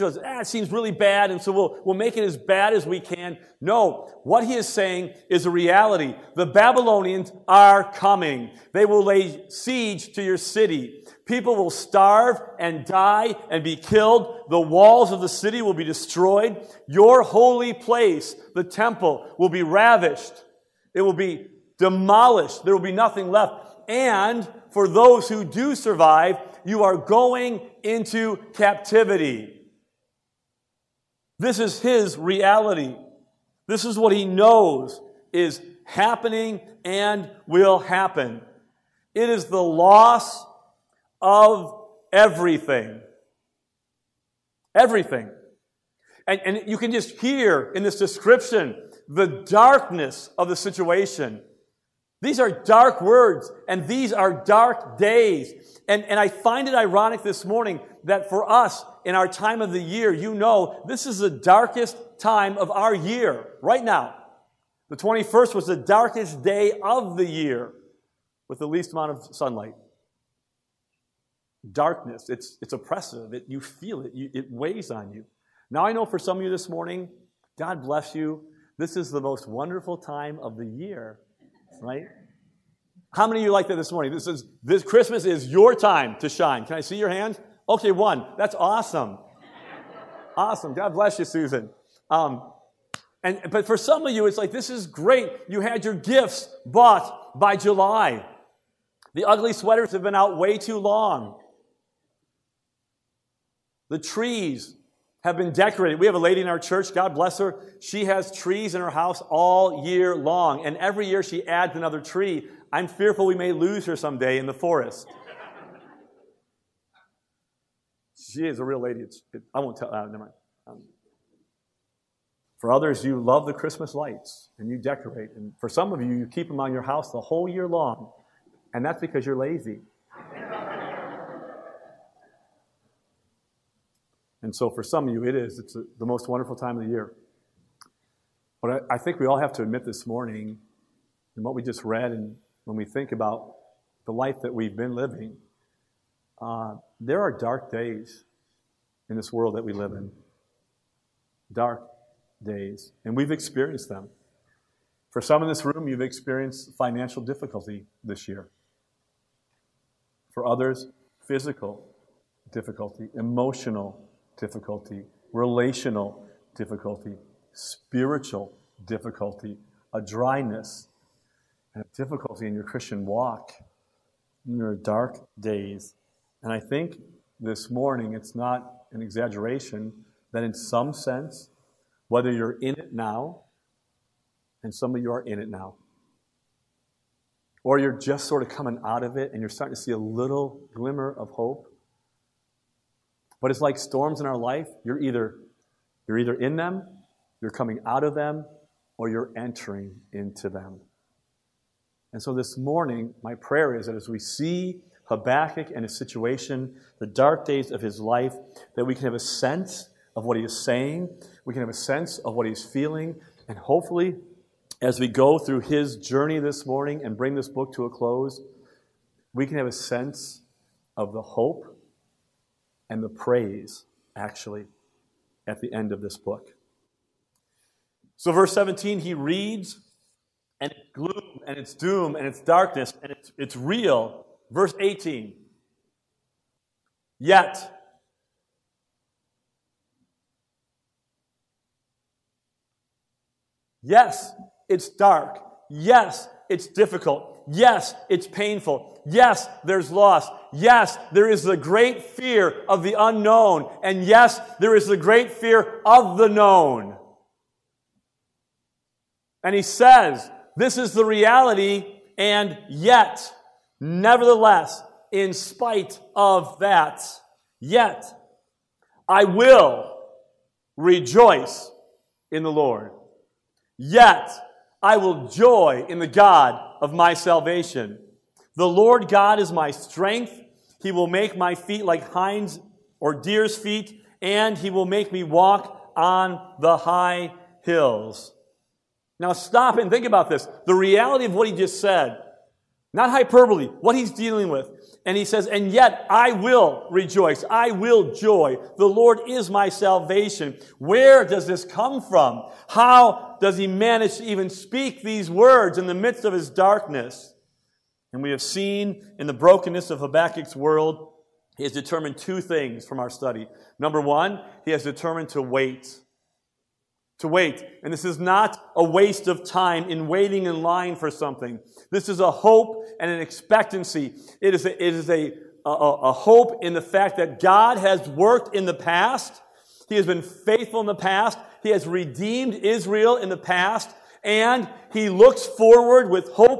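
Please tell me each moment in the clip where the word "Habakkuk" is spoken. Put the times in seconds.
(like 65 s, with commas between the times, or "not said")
205 s, 310 s.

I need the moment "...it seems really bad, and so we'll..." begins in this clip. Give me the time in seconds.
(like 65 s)
0 s.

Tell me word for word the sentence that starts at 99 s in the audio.
The ugly sweaters have been out way too long.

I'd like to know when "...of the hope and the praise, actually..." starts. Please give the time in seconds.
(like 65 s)
220 s.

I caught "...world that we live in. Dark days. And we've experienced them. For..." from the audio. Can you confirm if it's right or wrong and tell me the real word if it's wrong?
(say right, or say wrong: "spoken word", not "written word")
right.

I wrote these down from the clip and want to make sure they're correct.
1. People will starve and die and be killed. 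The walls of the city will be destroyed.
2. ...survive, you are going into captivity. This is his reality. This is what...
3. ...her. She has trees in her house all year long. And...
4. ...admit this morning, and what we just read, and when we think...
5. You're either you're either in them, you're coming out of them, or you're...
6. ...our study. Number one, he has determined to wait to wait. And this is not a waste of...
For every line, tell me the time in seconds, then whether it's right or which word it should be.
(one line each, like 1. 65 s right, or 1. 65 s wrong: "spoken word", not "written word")
1. 11 s right
2. 25 s right
3. 107 s right
4. 139 s right
5. 194 s right
6. 312 s right.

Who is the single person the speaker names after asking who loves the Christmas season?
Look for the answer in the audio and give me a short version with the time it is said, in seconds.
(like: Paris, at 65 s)
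Susan, at 90 s.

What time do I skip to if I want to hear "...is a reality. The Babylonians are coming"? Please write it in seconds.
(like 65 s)
5 s.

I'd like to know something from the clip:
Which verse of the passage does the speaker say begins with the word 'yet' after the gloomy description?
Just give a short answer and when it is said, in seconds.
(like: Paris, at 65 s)
18, at 234 s.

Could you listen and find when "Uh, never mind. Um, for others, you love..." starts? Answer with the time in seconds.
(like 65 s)
119 s.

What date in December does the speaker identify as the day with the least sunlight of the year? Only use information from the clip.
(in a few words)
21st.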